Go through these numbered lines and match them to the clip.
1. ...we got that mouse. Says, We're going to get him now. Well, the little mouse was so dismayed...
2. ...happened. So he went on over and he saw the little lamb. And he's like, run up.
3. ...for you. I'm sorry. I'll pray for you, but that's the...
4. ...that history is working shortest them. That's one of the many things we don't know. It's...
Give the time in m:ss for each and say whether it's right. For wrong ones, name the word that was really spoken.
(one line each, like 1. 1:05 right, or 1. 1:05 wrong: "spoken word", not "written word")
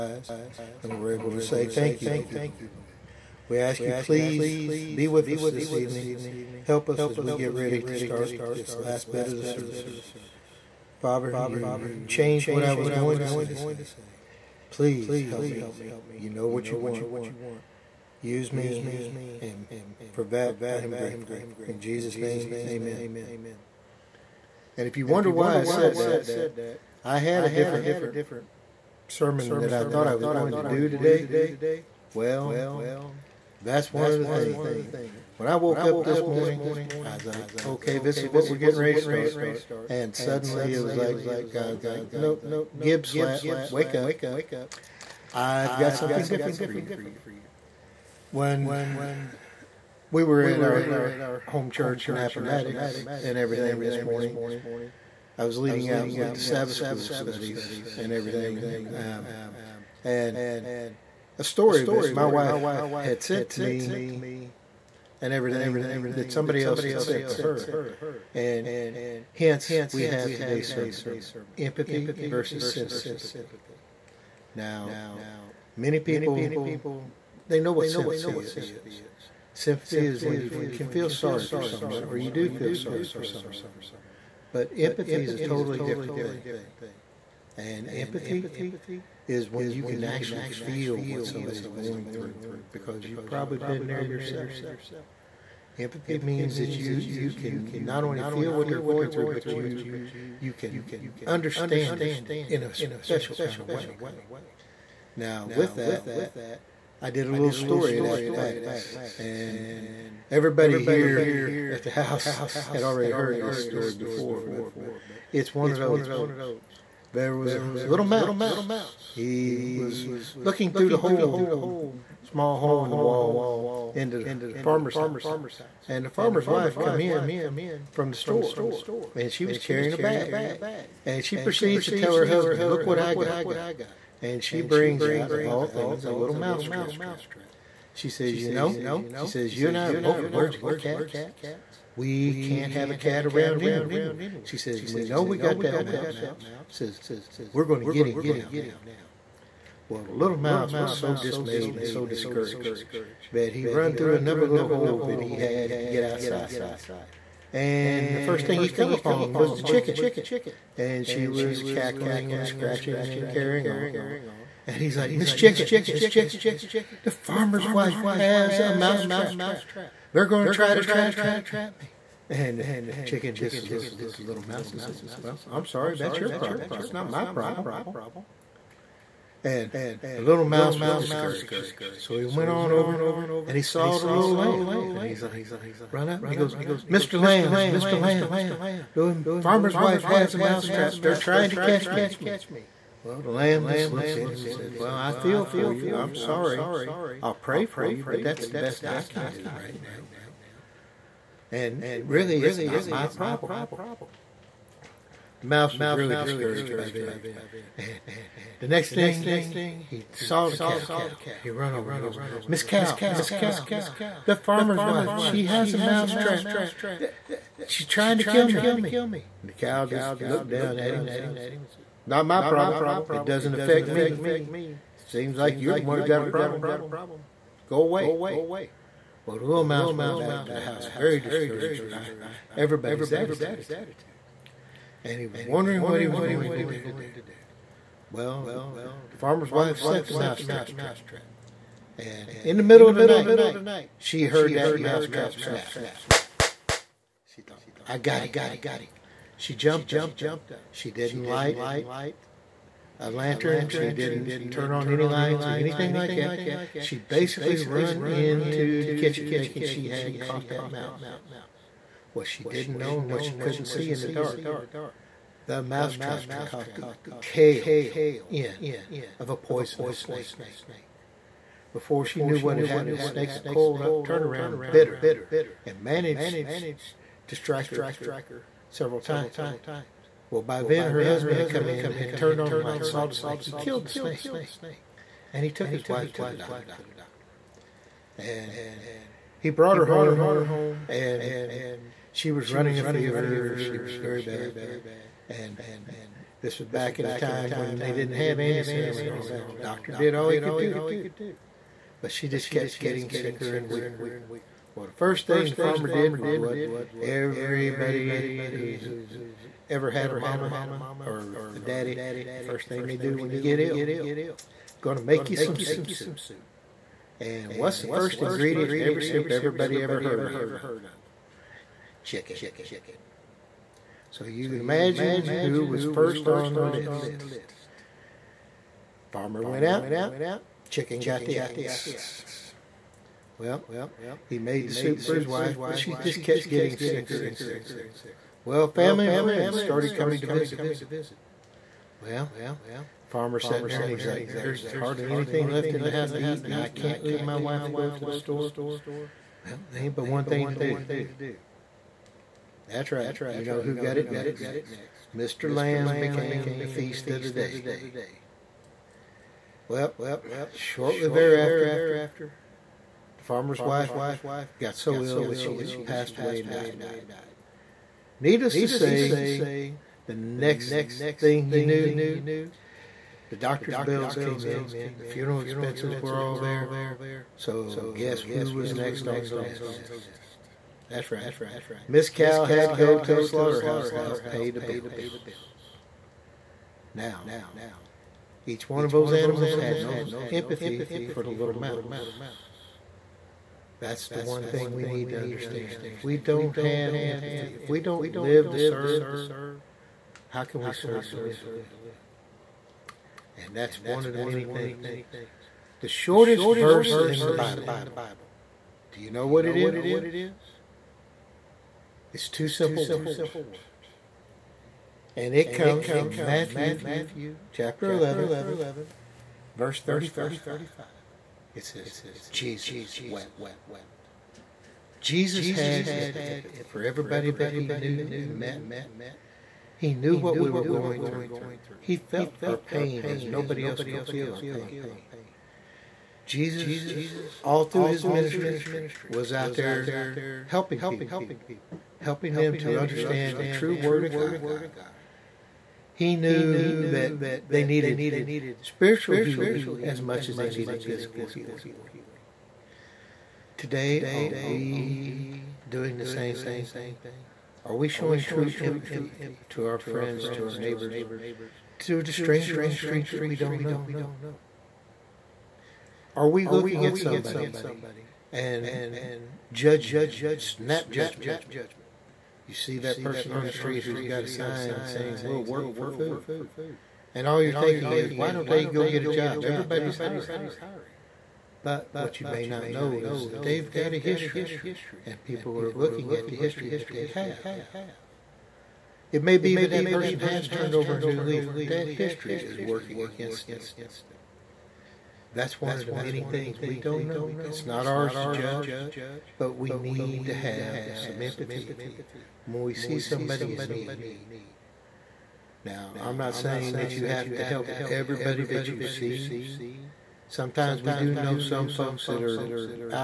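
1. 2:25 right
2. 3:00 wrong: "discouraged", not "happened"
3. 3:15 right
4. 8:11 wrong: "against", not "shortest".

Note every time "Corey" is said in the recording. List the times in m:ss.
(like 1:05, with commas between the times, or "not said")
not said.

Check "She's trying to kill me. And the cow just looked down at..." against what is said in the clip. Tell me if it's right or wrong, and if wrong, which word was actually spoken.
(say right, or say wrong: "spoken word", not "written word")
right.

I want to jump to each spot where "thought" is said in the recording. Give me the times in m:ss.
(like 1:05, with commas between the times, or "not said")
0:29, 4:07.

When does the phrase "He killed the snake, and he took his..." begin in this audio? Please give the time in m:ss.
4:43.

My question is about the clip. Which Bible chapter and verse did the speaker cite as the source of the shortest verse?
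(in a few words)
Matthew 11:35.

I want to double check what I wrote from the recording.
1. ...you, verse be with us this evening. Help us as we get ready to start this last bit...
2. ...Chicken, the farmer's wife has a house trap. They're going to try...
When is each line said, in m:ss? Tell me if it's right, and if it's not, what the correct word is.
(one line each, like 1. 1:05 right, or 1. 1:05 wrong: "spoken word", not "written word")
1. 0:03 wrong: "please", not "verse"
2. 2:46 wrong: "mouse", not "house".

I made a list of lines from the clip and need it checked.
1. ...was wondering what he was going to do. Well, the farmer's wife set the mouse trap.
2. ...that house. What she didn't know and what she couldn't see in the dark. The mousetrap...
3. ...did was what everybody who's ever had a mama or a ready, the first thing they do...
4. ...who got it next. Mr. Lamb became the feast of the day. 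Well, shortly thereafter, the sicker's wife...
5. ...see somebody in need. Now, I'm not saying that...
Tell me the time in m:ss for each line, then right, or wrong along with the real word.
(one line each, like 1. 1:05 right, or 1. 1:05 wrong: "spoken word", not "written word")
1. 3:55 right
2. 4:20 wrong: "mouse", not "house"
3. 5:05 wrong: "daddy", not "ready"
4. 5:53 wrong: "farmer", not "sicker"
5. 8:22 right.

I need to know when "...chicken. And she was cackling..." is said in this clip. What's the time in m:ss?
2:39.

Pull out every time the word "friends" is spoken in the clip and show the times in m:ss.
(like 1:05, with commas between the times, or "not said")
5:39, 7:39.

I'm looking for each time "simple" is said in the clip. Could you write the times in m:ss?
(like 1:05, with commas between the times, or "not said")
6:52.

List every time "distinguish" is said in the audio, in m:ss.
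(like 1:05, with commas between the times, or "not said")
not said.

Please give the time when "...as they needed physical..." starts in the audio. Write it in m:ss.
7:30.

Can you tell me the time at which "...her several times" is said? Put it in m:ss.
4:37.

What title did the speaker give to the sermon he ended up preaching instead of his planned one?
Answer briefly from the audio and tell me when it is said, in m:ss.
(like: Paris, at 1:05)
Empathy versus sympathy, at 1:11.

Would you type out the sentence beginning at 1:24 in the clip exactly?
But empathy is a totally different thing.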